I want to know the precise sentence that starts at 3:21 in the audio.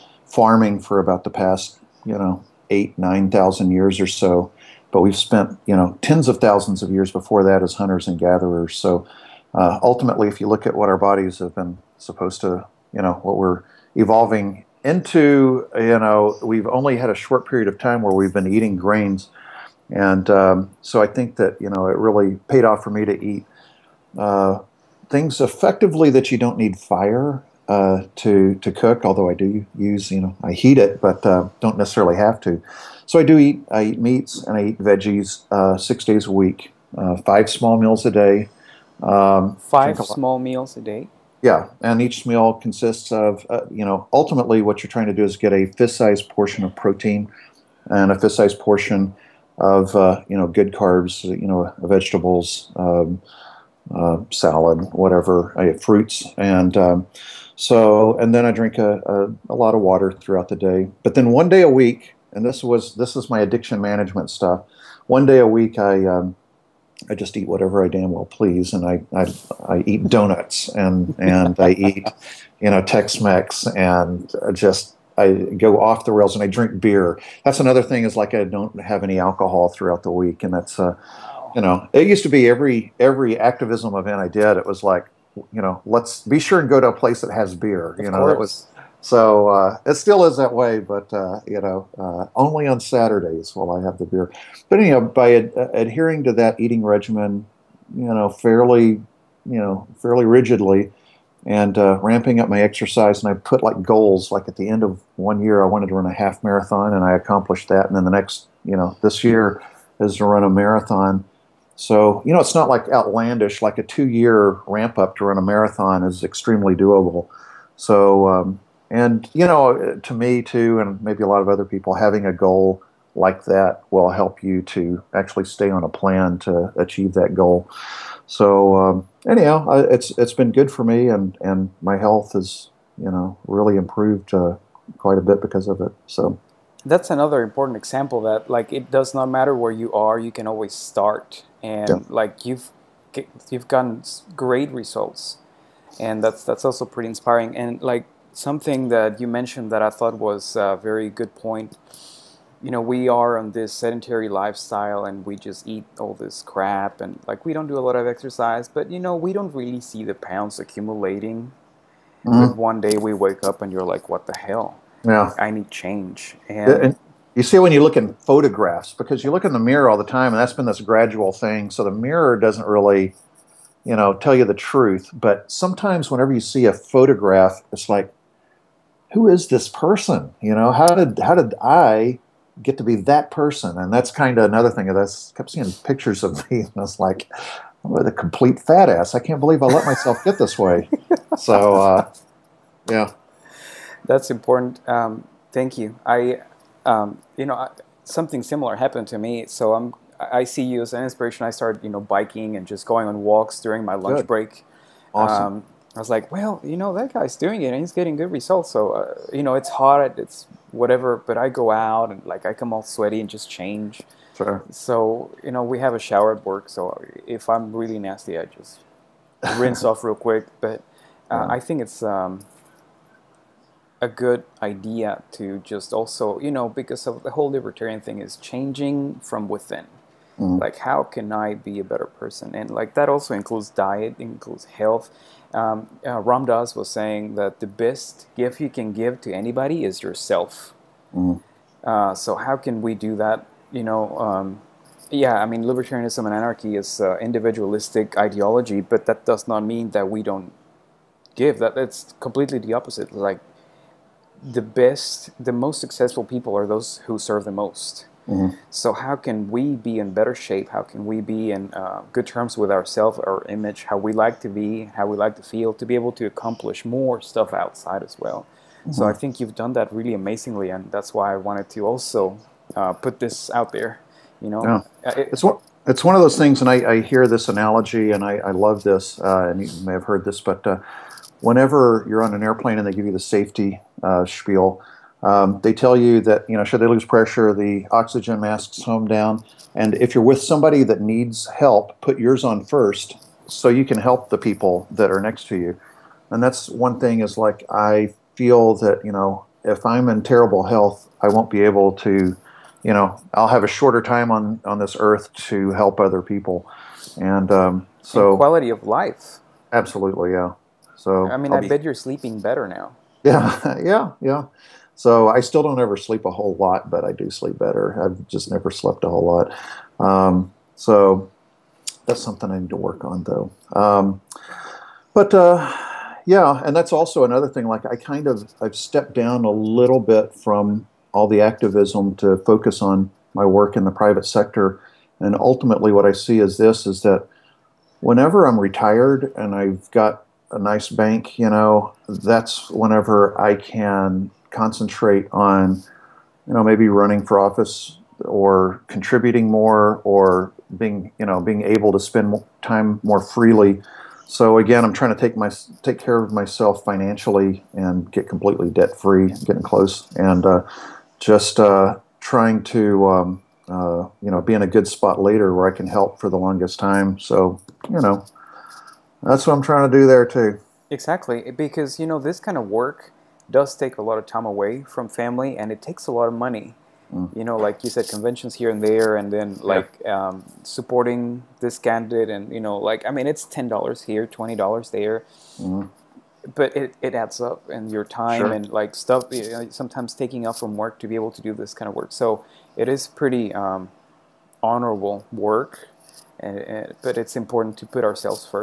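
I started, you know, biking and just going on walks during my lunch Good.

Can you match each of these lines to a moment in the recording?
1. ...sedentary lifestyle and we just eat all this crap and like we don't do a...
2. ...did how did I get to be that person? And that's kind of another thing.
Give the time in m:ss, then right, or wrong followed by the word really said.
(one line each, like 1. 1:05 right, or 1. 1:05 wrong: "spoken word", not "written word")
1. 2:33 right
2. 3:00 right.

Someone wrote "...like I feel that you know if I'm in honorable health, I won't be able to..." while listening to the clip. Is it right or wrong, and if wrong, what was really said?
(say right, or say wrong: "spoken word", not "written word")
wrong: "terrible", not "honorable".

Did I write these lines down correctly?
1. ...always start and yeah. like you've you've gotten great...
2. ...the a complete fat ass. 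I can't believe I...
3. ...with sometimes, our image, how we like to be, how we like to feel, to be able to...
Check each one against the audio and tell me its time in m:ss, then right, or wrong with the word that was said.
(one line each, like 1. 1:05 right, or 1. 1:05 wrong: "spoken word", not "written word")
1. 2:20 right
2. 3:07 right
3. 4:22 wrong: "ourselves", not "sometimes".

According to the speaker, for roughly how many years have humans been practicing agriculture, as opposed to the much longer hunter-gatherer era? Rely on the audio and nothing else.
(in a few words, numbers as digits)
8-9 thousand years.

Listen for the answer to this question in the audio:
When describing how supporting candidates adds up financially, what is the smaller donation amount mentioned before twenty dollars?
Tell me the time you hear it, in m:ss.
6:23.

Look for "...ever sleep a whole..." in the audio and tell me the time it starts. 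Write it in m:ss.
5:15.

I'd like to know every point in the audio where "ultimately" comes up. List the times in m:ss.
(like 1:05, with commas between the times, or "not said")
0:09, 0:44, 5:35.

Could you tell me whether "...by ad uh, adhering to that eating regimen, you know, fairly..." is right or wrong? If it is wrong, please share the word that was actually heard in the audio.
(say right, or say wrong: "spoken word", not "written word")
right.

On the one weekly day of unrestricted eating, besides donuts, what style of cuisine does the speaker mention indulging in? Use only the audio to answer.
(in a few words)
Tex-Mex.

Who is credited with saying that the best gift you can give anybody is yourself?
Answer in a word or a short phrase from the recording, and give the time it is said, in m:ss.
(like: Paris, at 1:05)
Ram Dass, at 3:56.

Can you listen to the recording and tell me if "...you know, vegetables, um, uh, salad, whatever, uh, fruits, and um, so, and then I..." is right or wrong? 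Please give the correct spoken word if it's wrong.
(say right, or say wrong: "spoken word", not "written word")
right.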